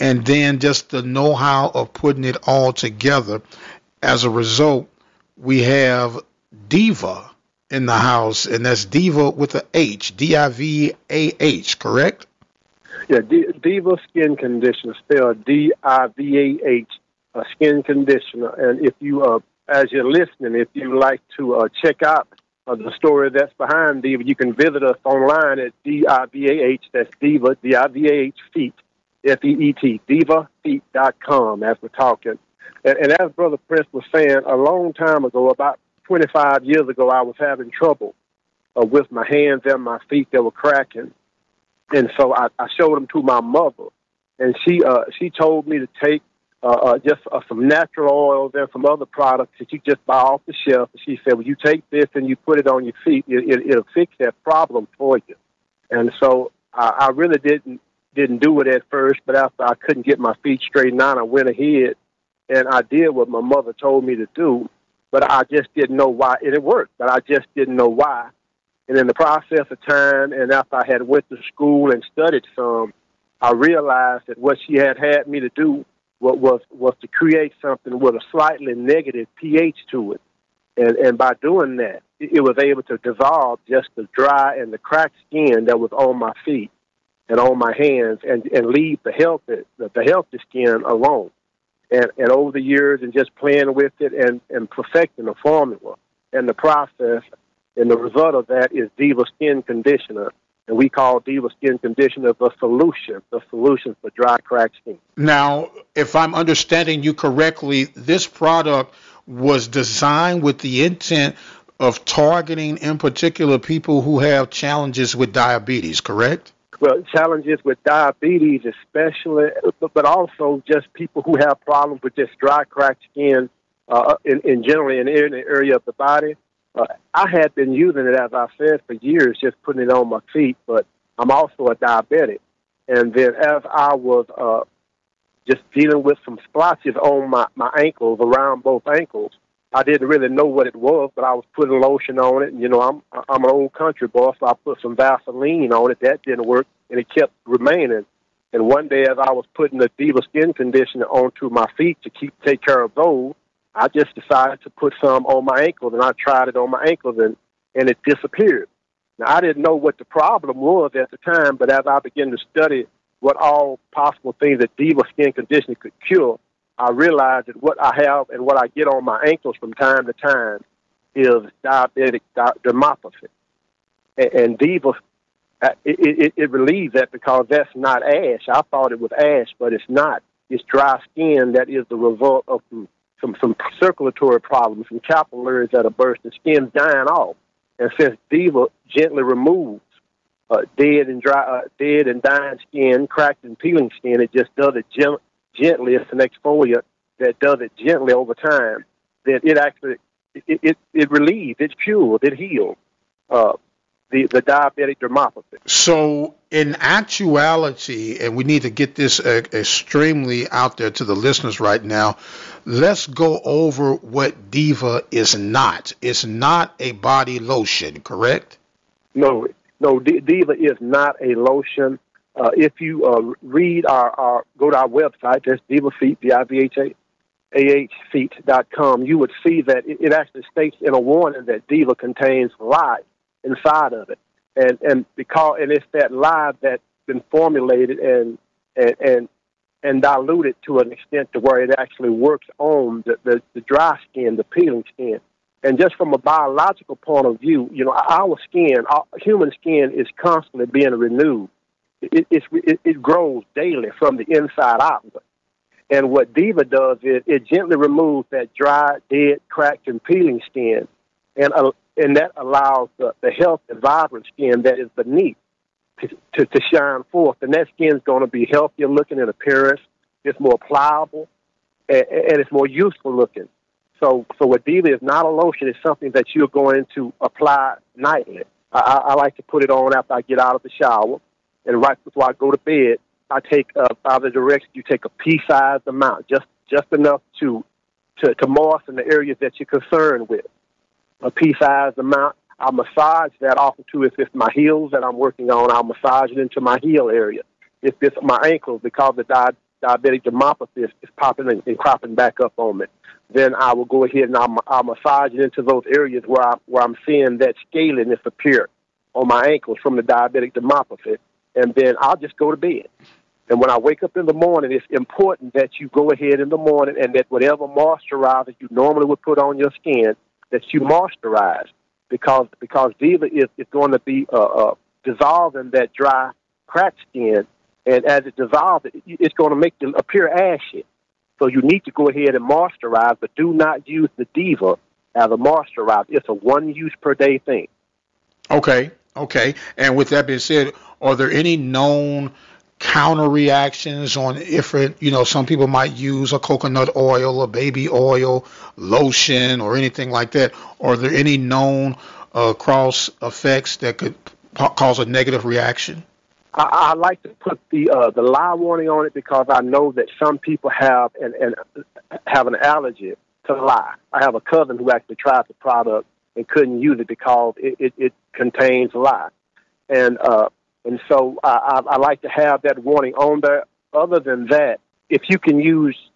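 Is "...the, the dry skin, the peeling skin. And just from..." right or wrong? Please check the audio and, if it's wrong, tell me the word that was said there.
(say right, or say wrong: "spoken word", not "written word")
right.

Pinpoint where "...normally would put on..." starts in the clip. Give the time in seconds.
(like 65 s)
318 s.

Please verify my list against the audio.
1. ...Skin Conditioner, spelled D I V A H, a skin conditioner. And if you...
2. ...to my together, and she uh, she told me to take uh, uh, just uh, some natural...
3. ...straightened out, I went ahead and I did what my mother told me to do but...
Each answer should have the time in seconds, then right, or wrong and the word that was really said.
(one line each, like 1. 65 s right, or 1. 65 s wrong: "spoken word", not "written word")
1. 14 s right
2. 43 s wrong: "mother", not "together"
3. 60 s right.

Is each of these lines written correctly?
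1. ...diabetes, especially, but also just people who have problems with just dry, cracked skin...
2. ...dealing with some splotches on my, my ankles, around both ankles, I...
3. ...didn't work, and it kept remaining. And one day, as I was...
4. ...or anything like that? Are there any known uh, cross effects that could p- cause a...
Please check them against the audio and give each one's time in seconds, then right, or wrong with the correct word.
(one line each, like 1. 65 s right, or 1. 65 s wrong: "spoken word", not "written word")
1. 117 s right
2. 135 s right
3. 146 s right
4. 349 s right.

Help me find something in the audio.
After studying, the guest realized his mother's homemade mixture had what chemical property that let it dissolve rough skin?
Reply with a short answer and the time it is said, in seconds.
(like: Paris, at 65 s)
A slightly negative pH, at 78 s.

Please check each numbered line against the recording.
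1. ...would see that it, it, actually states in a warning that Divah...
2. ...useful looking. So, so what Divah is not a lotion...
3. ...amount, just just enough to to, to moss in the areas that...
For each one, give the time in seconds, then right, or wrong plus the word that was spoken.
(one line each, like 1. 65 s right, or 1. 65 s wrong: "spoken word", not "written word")
1. 229 s right
2. 272 s right
3. 285 s right.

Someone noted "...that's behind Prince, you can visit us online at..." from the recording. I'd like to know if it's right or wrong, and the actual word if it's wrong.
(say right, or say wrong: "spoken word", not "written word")
wrong: "Divah", not "Prince".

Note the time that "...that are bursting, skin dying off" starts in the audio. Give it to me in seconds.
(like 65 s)
185 s.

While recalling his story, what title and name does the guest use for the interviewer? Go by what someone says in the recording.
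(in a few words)
Brother Prince.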